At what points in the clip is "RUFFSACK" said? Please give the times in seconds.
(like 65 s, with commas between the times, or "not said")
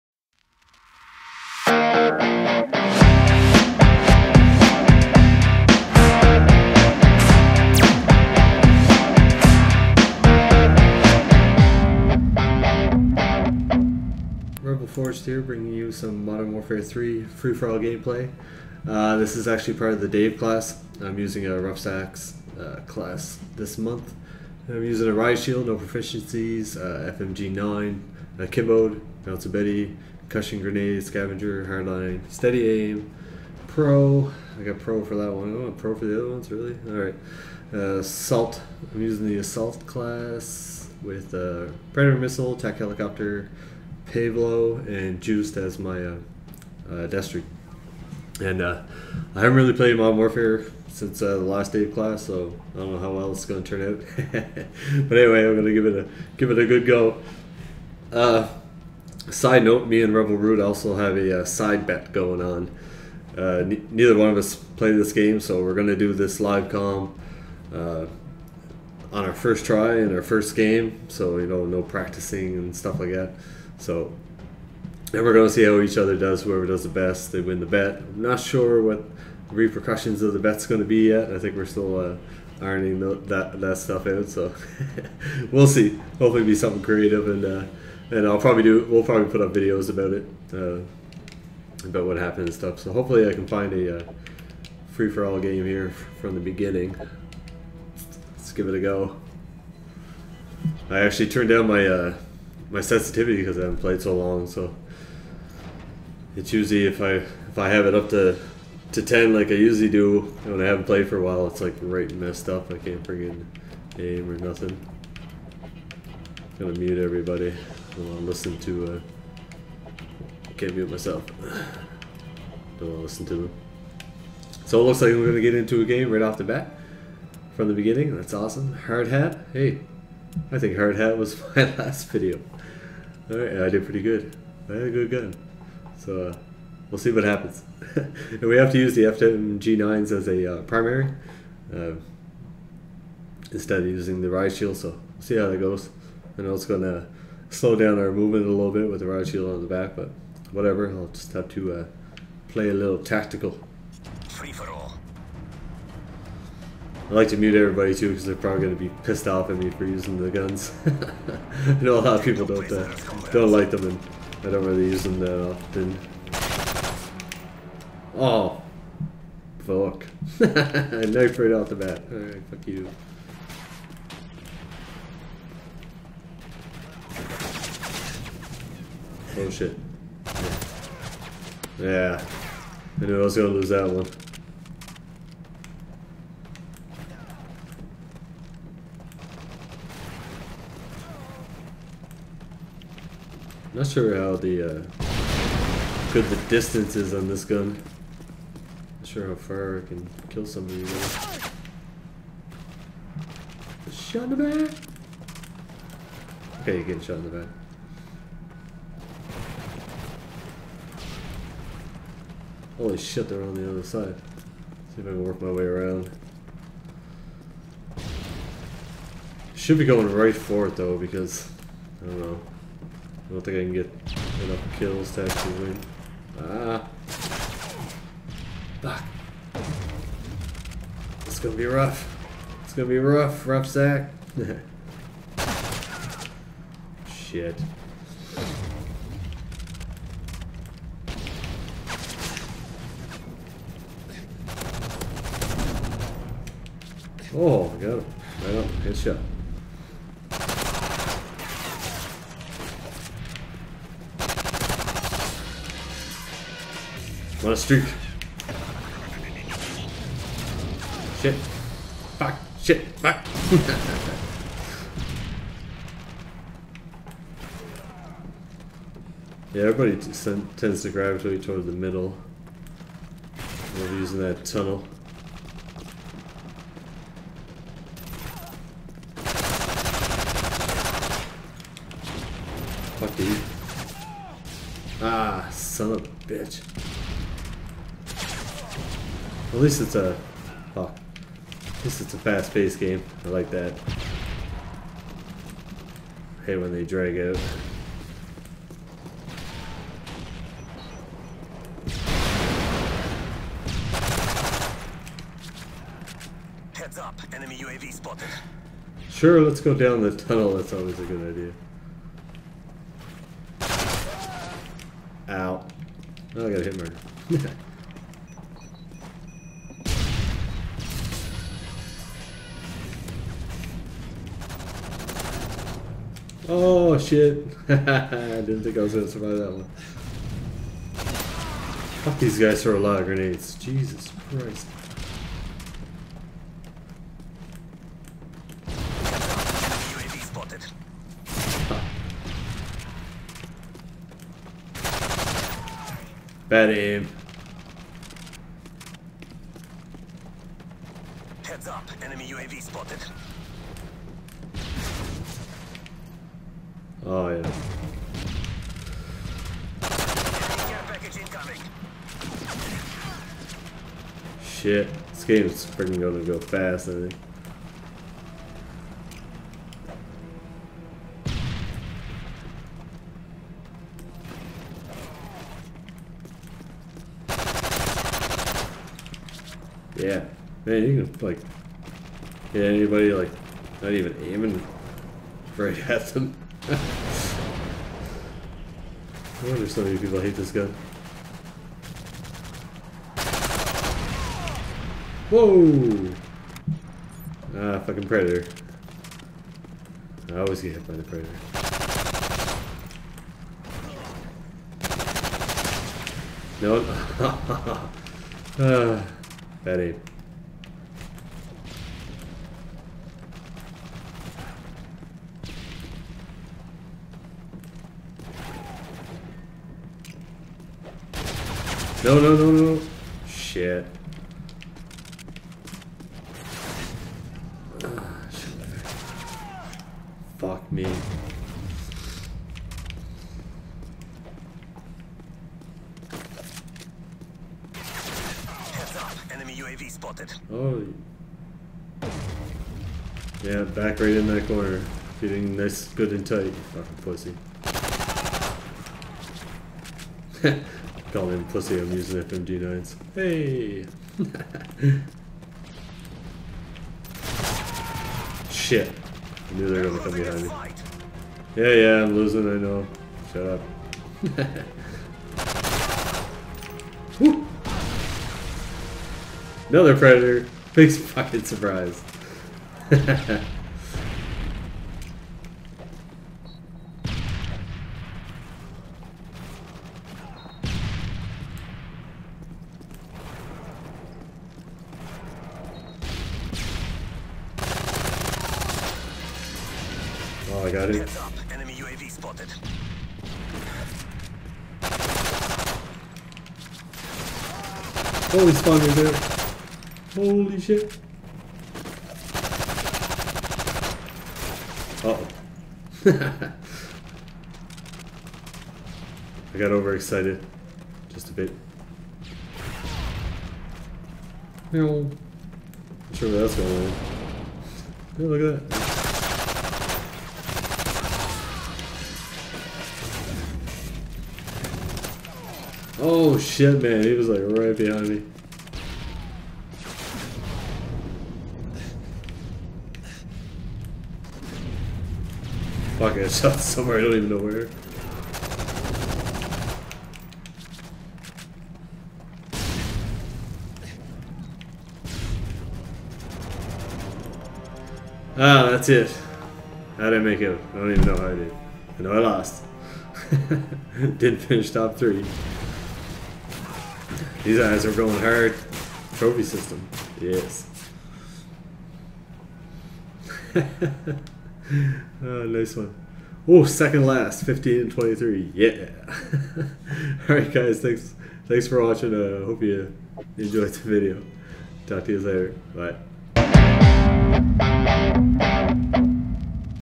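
21 s, 233 s.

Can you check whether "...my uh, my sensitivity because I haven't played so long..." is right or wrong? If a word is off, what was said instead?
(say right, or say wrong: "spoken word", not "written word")
right.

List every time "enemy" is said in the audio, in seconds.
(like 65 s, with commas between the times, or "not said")
307 s, 352 s, 491 s.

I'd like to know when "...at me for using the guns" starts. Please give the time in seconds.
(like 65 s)
159 s.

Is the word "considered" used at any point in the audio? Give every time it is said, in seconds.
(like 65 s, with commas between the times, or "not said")
not said.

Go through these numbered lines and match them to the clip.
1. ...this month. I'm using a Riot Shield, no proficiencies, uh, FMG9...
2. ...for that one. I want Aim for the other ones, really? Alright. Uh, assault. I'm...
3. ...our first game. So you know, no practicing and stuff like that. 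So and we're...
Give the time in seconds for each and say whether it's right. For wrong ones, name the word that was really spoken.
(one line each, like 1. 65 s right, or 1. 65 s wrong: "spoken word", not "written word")
1. 23 s right
2. 35 s wrong: "Pro", not "Aim"
3. 70 s right.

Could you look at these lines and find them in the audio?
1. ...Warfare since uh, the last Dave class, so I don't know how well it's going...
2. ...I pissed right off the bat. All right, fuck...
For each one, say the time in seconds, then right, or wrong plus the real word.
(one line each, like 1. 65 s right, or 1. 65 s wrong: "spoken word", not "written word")
1. 50 s right
2. 170 s wrong: "knifed", not "pissed".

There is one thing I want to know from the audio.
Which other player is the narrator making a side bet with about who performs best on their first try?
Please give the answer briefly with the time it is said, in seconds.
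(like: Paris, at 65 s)
Rebel Brute, at 60 s.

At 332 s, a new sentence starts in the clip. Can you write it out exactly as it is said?
Fuck these guys throw a lot of grenades.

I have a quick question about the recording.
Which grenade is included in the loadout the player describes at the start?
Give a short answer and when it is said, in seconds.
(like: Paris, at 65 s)
Concussion Grenade, at 30 s.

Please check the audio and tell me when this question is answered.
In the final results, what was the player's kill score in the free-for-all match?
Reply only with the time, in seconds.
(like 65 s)
567 s.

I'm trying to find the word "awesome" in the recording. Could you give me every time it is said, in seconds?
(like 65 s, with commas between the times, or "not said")
128 s.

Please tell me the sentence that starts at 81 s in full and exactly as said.
I think we're still uh, ironing the, that that stuff out.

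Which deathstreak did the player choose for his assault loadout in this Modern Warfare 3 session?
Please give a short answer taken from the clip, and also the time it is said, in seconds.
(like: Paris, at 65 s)
Juiced, at 45 s.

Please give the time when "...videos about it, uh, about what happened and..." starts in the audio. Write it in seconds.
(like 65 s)
89 s.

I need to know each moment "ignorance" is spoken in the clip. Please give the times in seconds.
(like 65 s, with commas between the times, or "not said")
not said.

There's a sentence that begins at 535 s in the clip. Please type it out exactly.
Fuck, I shot somewhere, I don't even know where.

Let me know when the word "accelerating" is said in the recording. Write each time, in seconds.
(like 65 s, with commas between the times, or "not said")
not said.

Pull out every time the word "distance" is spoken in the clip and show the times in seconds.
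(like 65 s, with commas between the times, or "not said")
196 s.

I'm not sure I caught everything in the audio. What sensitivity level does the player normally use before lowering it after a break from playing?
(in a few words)
10.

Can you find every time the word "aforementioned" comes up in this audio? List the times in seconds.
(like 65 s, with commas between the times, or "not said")
not said.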